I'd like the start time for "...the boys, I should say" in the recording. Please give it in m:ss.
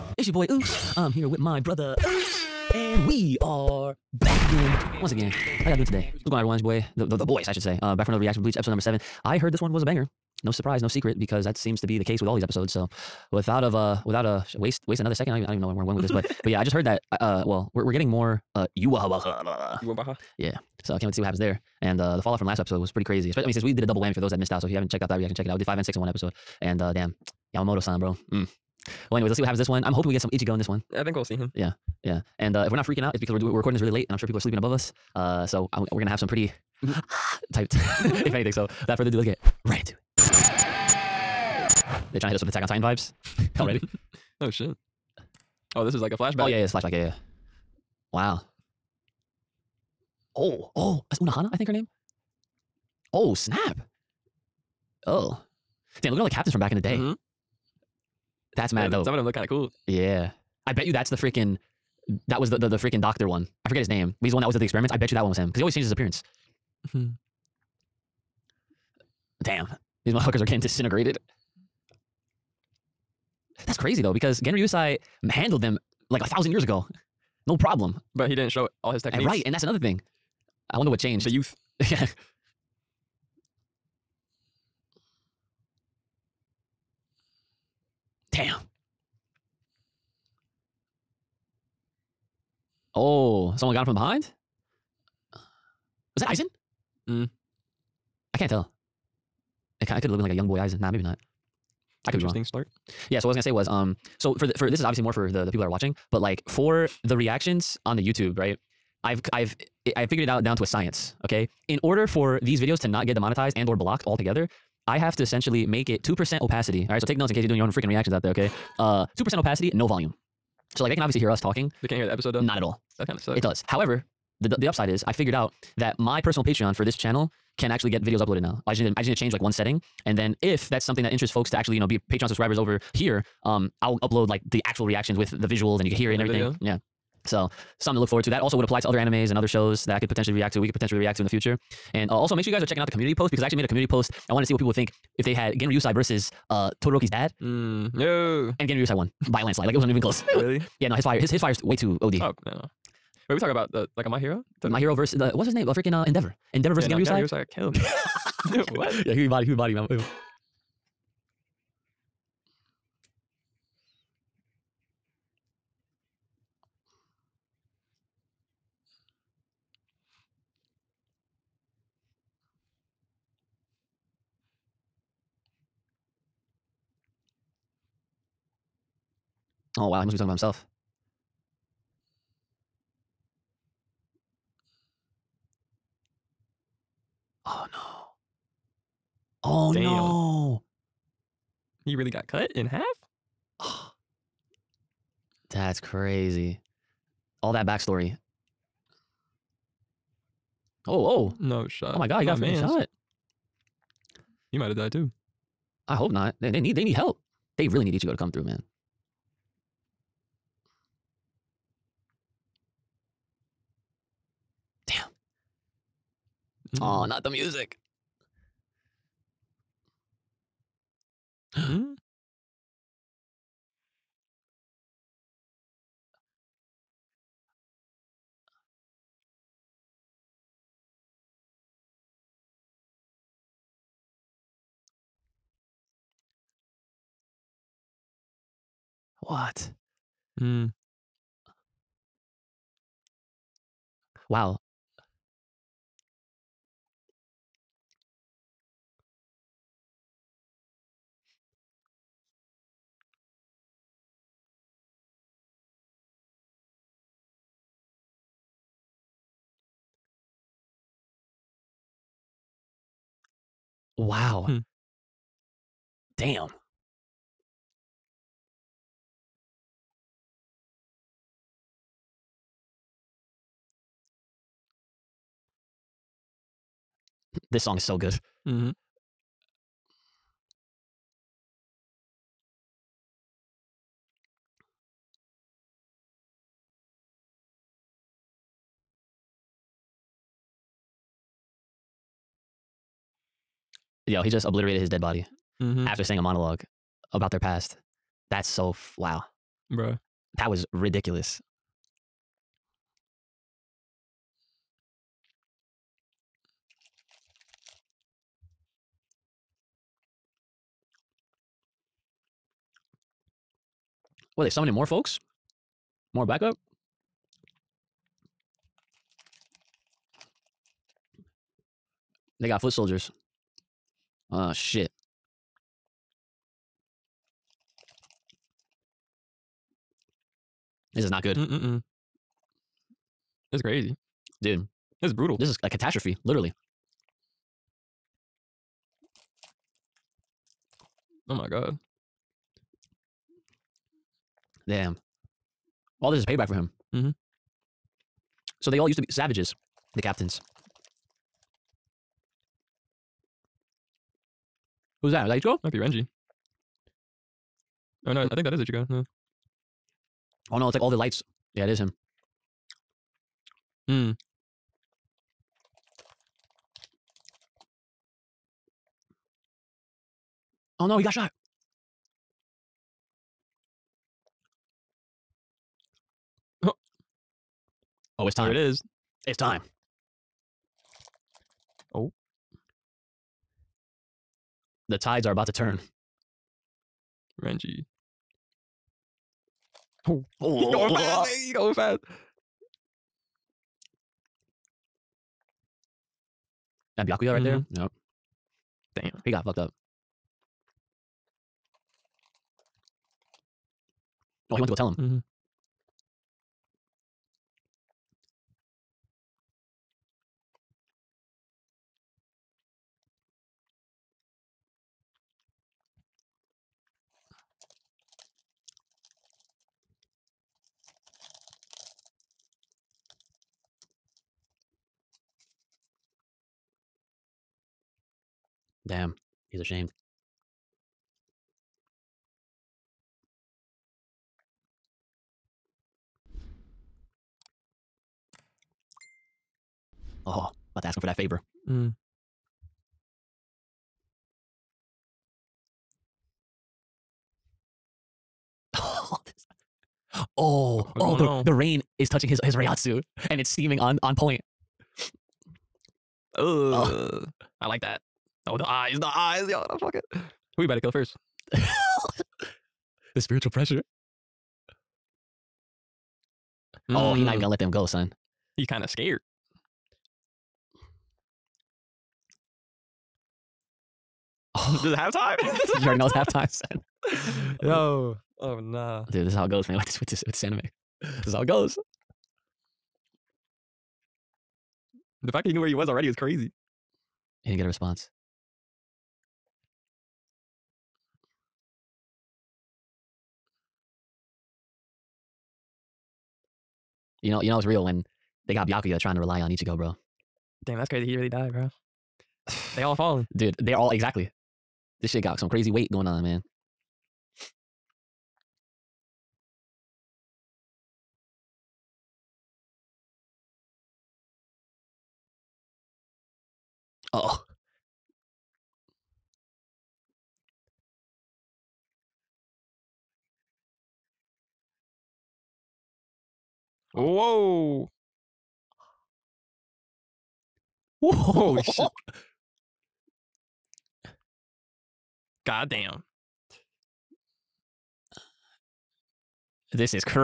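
0:07.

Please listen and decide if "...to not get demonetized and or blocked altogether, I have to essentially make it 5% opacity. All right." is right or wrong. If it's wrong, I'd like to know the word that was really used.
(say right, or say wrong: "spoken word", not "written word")
wrong: "2", not "5".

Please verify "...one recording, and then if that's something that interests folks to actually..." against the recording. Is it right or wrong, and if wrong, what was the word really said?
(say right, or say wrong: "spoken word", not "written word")
wrong: "setting", not "recording".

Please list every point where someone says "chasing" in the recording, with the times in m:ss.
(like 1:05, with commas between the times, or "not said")
not said.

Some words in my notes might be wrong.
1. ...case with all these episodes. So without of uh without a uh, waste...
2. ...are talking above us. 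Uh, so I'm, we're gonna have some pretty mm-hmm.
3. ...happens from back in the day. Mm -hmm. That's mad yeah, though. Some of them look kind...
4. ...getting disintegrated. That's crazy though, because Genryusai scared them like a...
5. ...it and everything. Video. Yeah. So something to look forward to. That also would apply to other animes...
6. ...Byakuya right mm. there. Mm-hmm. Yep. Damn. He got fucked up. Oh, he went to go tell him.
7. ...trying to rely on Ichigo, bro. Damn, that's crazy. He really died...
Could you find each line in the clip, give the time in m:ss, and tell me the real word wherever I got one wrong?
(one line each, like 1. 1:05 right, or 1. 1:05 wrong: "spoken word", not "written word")
1. 0:12 right
2. 0:34 wrong: "sleeping", not "talking"
3. 0:56 wrong: "captains", not "happens"
4. 1:10 wrong: "handled", not "scared"
5. 2:16 right
6. 6:37 right
7. 8:18 right.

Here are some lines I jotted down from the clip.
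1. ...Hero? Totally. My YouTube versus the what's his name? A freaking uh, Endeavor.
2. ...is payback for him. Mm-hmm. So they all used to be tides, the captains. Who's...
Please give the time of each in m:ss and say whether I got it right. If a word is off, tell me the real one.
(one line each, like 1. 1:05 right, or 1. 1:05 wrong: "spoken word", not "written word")
1. 2:34 wrong: "Hero", not "YouTube"
2. 5:46 wrong: "savages", not "tides".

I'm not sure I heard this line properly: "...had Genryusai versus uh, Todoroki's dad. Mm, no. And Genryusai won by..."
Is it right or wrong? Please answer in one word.
right.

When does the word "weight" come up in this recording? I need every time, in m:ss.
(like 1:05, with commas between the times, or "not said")
8:25.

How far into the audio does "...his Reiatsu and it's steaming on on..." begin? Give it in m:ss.
7:32.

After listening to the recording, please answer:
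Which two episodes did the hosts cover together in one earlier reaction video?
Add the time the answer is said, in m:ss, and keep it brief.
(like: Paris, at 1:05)
5 and 6, at 0:25.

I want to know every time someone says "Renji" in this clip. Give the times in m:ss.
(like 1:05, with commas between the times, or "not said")
5:55, 6:27.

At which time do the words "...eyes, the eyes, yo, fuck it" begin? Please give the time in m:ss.
7:38.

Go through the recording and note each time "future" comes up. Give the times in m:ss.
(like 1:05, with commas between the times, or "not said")
2:21.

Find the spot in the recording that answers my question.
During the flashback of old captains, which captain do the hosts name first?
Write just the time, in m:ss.
0:51.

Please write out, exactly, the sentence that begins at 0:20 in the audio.
So I can't wait to see what happens there.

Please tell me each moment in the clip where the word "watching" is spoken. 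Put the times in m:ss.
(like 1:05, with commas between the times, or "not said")
1:45.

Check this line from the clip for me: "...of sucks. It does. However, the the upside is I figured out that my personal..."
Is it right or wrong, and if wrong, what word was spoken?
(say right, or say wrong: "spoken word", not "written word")
right.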